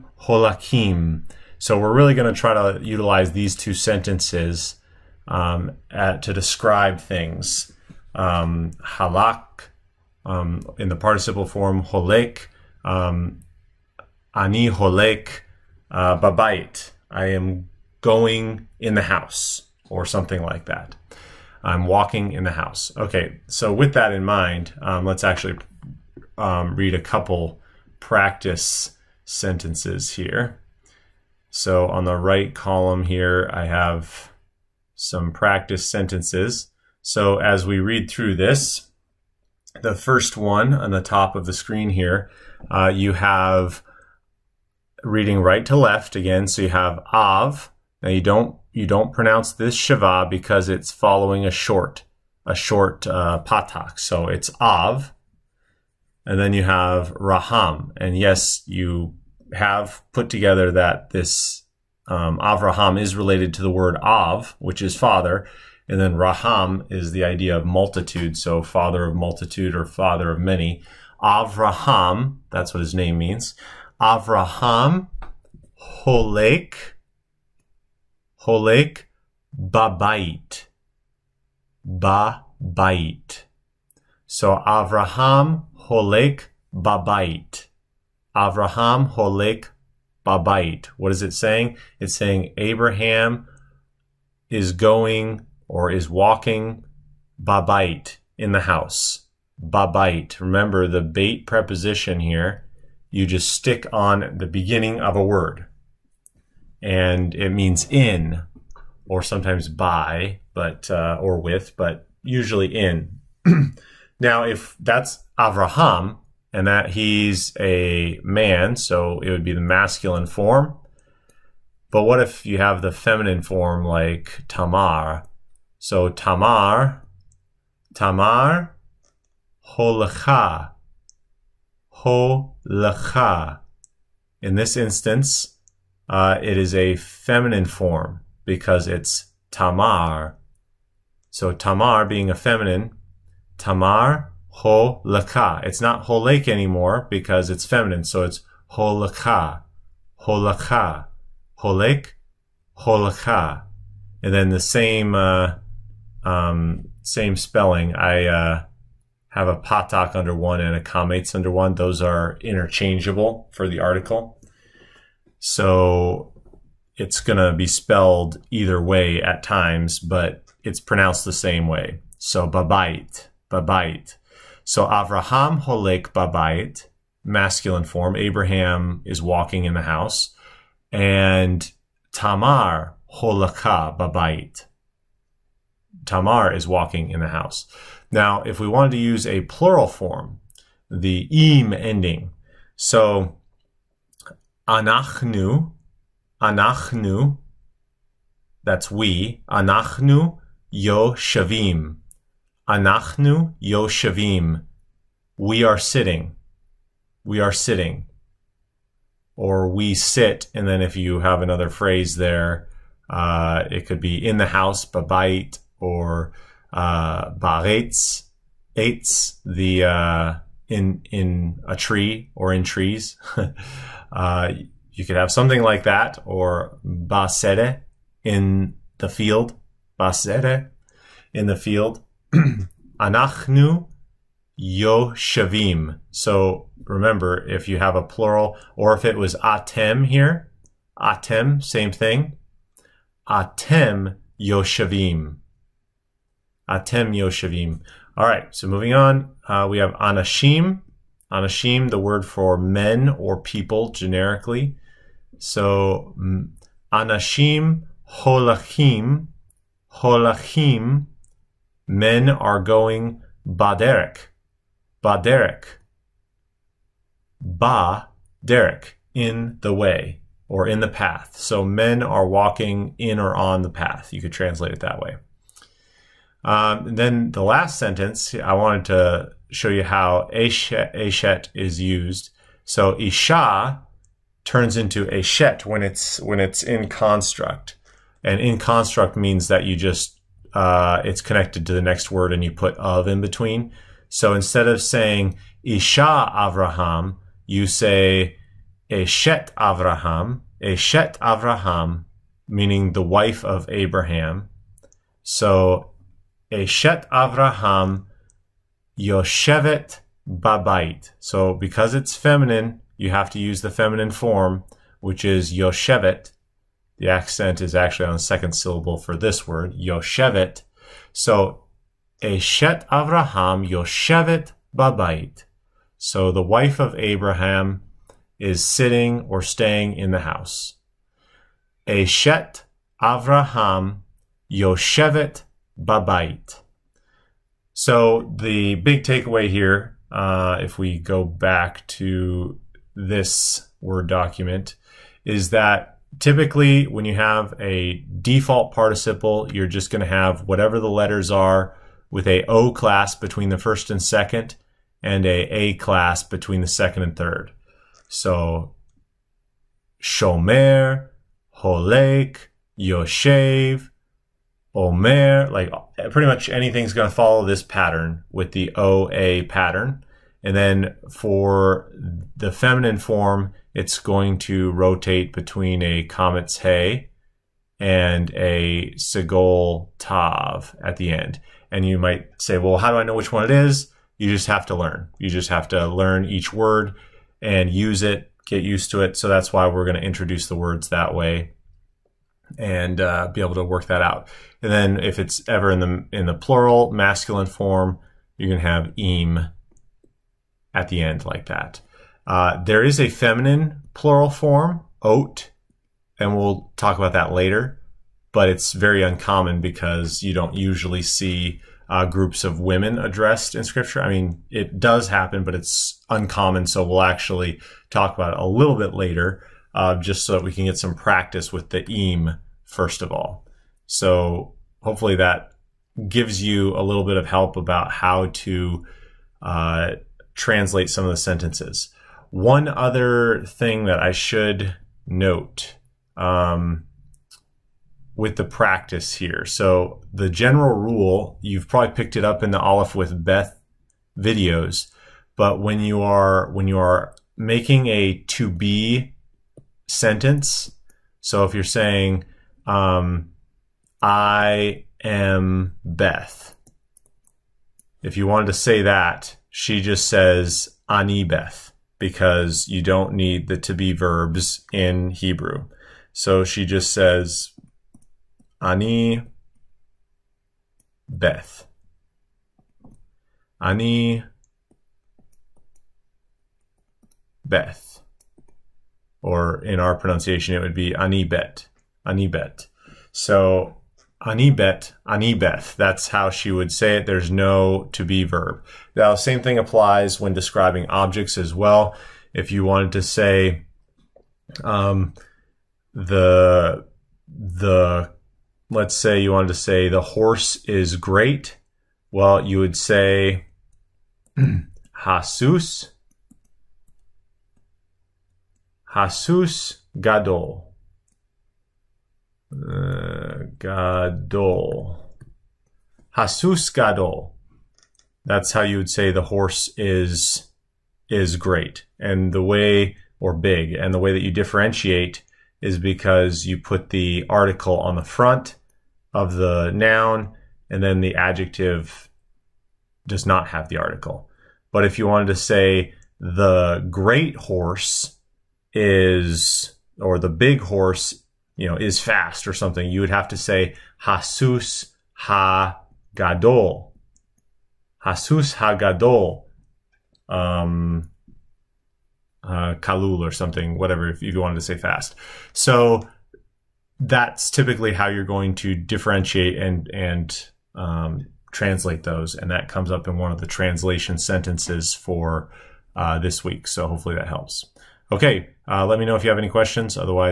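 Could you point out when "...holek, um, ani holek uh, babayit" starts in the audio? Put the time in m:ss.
0:11.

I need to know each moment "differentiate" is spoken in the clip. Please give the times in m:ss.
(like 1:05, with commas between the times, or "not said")
8:44, 9:18.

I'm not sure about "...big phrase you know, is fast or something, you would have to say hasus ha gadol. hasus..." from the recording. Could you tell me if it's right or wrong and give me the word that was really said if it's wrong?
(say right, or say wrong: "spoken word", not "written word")
wrong: "horse", not "phrase".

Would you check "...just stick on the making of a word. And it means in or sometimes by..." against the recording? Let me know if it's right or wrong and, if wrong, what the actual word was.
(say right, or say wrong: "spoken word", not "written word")
wrong: "beginning", not "making".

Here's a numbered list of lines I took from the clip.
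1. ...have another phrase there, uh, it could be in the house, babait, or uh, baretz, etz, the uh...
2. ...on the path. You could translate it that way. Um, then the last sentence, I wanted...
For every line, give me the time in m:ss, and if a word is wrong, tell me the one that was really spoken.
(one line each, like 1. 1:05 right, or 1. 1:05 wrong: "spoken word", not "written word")
1. 3:31 right
2. 4:33 right.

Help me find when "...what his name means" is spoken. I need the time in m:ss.
1:12.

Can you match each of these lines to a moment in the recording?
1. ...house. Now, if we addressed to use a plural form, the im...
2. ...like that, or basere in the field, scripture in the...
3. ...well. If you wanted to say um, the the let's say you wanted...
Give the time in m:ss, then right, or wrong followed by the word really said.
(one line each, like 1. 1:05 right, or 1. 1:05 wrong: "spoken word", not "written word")
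1. 3:07 wrong: "wanted", not "addressed"
2. 3:45 wrong: "basere", not "scripture"
3. 8:11 right.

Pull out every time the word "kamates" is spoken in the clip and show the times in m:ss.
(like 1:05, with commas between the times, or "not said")
2:40.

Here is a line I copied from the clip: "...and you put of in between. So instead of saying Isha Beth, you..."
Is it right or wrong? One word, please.
wrong.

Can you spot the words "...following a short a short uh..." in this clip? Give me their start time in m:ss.
0:50.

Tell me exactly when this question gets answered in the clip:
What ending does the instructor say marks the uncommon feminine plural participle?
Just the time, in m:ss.
6:45.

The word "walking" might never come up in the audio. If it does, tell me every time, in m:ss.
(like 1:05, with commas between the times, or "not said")
0:21, 1:36, 2:59, 3:06, 4:32.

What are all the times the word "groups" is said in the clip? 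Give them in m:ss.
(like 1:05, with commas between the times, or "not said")
6:52.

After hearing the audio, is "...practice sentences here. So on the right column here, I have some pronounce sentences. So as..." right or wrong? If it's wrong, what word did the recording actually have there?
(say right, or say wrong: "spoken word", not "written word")
wrong: "practice", not "pronounce".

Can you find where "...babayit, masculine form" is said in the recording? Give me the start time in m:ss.
2:56.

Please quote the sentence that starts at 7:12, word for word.
One other thing that I should note um, with the practice here.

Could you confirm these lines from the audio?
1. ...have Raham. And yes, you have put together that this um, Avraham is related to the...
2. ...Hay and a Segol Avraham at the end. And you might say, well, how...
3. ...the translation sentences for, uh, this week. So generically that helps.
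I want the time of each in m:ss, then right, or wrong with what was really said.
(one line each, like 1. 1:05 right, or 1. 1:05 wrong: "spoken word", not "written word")
1. 0:56 right
2. 6:16 wrong: "Tav", not "Avraham"
3. 9:23 wrong: "hopefully", not "generically".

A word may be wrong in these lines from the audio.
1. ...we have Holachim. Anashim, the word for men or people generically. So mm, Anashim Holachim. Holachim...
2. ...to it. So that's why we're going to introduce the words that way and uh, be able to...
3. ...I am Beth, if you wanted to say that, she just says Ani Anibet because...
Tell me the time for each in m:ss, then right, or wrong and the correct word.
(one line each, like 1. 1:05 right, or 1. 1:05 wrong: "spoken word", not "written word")
1. 4:09 wrong: "Anashim", not "Holachim"
2. 6:28 right
3. 7:34 wrong: "Beth", not "Anibet".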